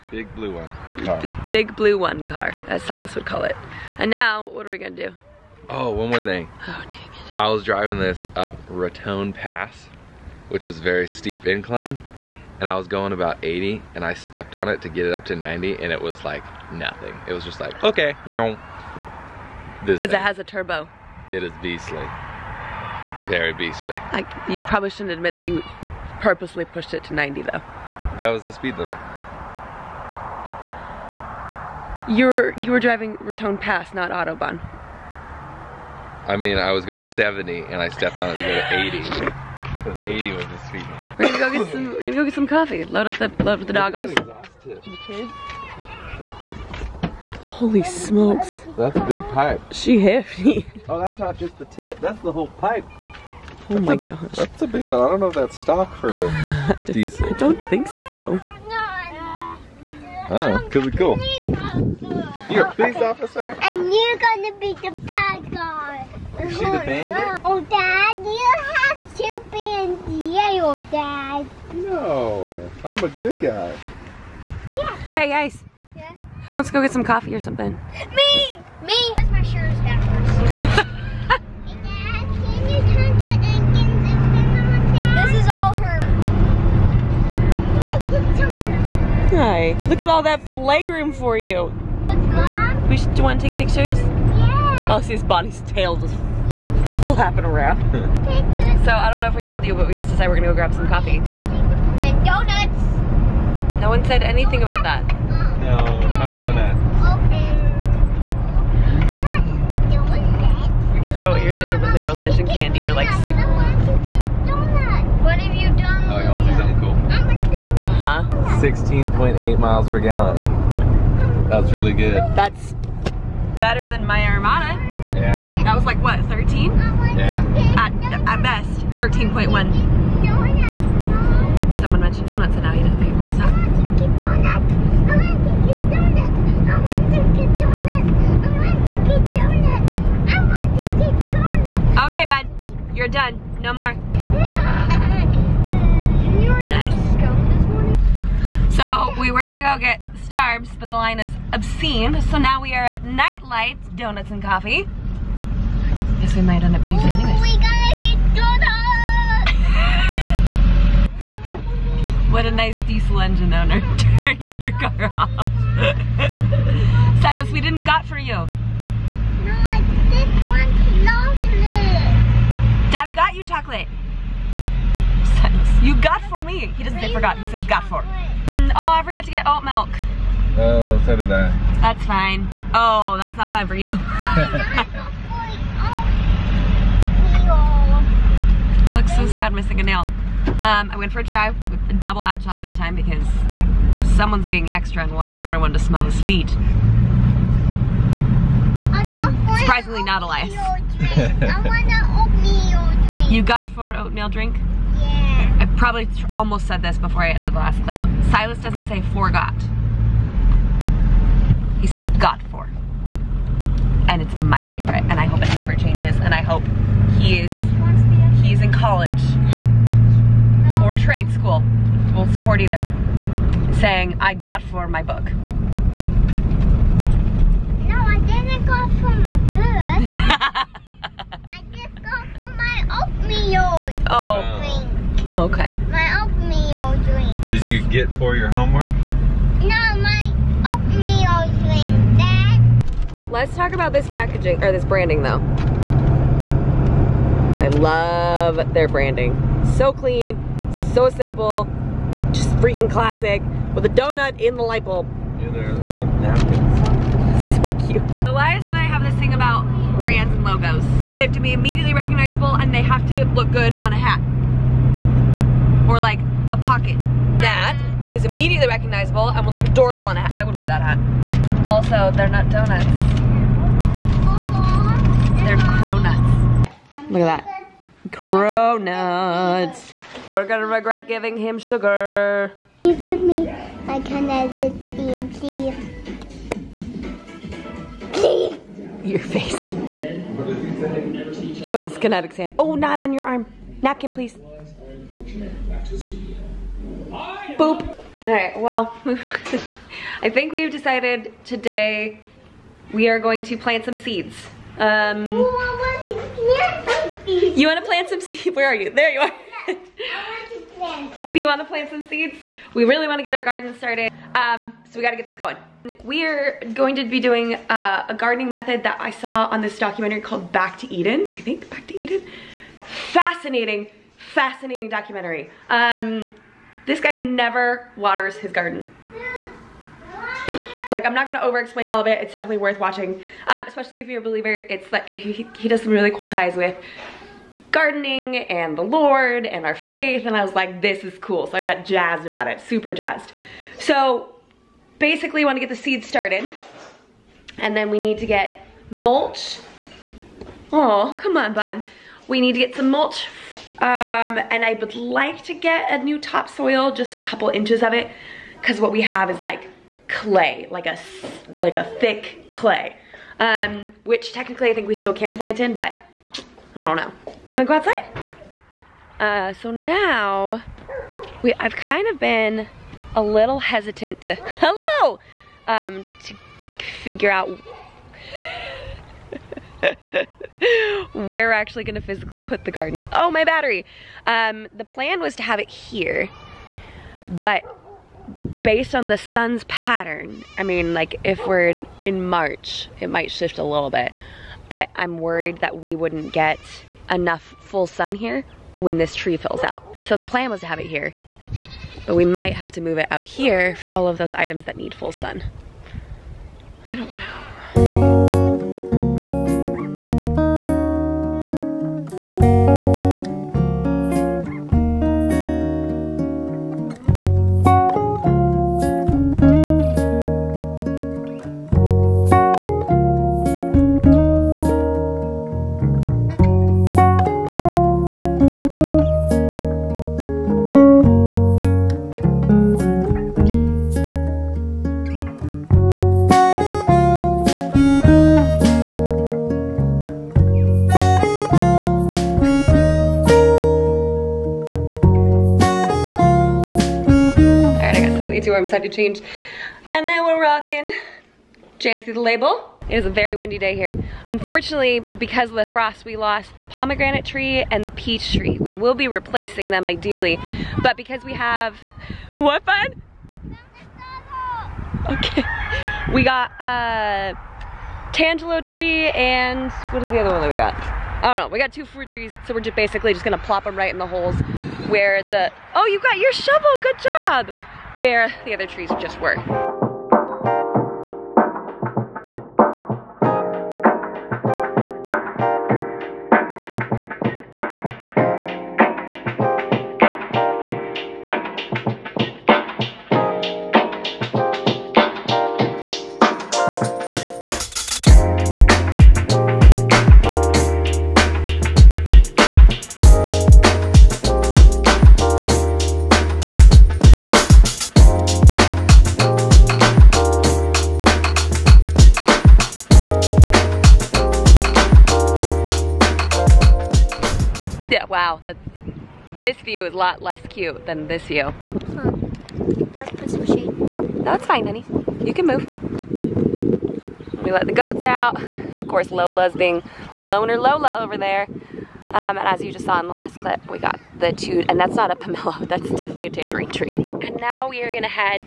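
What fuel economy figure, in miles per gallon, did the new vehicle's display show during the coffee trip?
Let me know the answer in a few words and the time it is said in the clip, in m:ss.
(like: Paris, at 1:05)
16.8, at 1:58.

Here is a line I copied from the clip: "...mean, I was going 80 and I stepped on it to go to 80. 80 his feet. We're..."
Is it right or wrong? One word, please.
wrong.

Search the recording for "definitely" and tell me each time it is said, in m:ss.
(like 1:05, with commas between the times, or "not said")
5:32, 8:55.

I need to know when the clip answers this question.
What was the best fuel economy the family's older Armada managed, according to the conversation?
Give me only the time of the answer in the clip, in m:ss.
2:08.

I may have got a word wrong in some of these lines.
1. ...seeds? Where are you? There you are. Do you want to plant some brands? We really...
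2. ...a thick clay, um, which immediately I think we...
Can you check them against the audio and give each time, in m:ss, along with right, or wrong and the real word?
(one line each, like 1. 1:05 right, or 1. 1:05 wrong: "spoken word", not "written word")
1. 5:08 wrong: "seeds", not "brands"
2. 6:01 wrong: "technically", not "immediately".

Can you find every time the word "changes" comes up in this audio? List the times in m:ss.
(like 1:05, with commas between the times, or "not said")
3:35, 7:28.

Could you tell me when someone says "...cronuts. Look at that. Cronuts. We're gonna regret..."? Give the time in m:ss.
4:35.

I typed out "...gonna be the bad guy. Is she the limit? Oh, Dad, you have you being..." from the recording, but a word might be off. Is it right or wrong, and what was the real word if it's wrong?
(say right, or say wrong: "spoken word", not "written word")
wrong: "bandit", not "limit".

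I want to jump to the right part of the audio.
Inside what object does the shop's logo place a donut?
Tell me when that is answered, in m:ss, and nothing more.
4:14.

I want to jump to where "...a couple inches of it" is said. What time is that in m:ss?
5:57.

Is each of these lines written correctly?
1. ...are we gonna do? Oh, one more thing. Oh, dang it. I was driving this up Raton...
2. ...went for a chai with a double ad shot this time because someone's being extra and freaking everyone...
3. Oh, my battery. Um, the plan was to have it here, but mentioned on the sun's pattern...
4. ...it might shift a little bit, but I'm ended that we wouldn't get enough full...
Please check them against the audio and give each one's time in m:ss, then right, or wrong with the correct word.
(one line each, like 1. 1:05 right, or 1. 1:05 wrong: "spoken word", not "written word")
1. 0:04 right
2. 3:10 wrong: "wanting", not "freaking"
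3. 6:23 wrong: "based", not "mentioned"
4. 6:32 wrong: "worried", not "ended".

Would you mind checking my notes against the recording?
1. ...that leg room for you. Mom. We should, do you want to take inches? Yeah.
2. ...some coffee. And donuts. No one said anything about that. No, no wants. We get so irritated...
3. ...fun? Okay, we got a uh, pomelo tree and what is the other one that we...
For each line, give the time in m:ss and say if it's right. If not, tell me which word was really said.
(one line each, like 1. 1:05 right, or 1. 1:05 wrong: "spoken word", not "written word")
1. 1:30 wrong: "pictures", not "inches"
2. 1:40 wrong: "donuts", not "wants"
3. 7:42 wrong: "tangelo", not "pomelo".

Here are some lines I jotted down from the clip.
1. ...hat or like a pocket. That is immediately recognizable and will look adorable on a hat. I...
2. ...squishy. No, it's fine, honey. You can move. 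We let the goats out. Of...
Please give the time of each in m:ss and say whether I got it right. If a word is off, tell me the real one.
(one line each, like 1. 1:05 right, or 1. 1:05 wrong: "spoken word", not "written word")
1. 4:23 right
2. 8:43 right.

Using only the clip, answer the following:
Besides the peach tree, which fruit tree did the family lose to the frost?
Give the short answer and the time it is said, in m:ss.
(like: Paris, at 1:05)
pomegranate tree, at 7:36.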